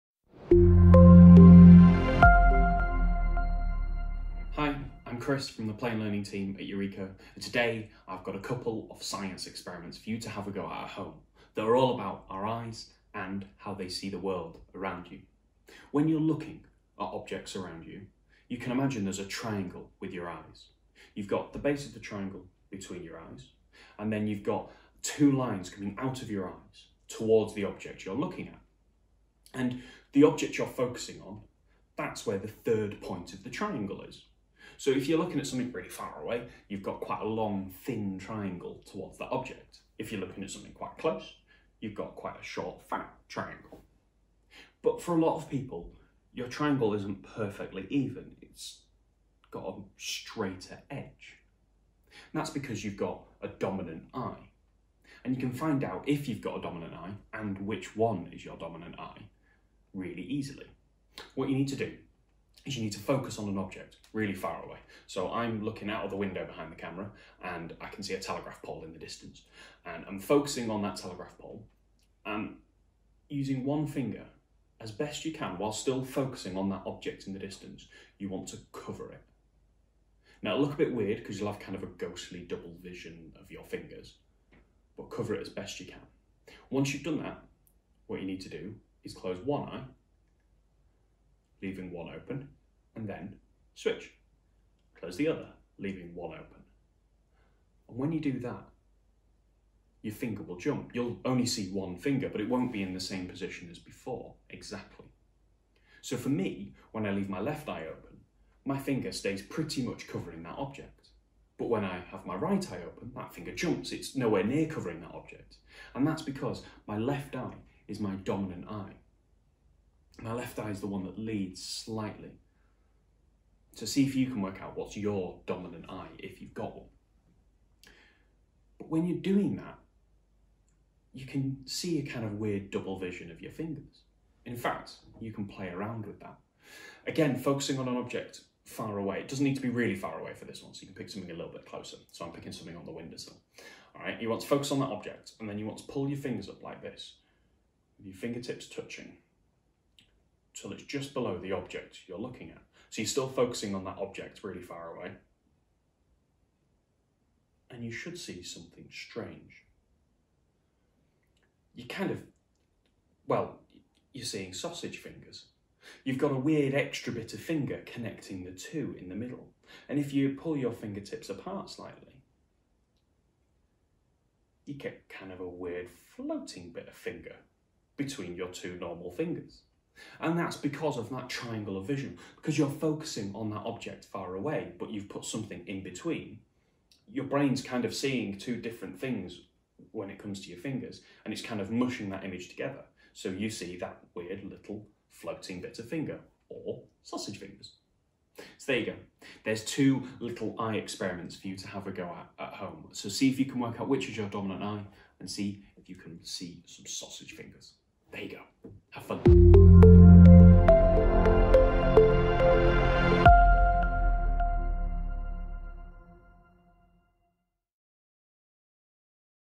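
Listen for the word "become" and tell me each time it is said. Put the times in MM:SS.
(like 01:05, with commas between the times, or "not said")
not said.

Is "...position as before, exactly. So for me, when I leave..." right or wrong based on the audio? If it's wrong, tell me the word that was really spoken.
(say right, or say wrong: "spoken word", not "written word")
right.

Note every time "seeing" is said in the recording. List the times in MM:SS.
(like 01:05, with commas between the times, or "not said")
02:44, 03:07.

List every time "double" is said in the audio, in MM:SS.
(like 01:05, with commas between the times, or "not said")
01:22, 02:12.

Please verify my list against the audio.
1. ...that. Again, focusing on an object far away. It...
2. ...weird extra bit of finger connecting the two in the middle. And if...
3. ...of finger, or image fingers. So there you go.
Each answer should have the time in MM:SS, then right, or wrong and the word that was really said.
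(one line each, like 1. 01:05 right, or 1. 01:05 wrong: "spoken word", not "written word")
1. 02:16 right
2. 02:46 right
3. 03:15 wrong: "sausage", not "image".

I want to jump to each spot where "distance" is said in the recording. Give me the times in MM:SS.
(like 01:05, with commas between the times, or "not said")
01:08, 01:17.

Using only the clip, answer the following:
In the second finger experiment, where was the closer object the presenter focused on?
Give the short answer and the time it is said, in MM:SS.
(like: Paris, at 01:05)
windowsill, at 02:22.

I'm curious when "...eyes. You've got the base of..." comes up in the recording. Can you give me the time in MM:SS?
00:20.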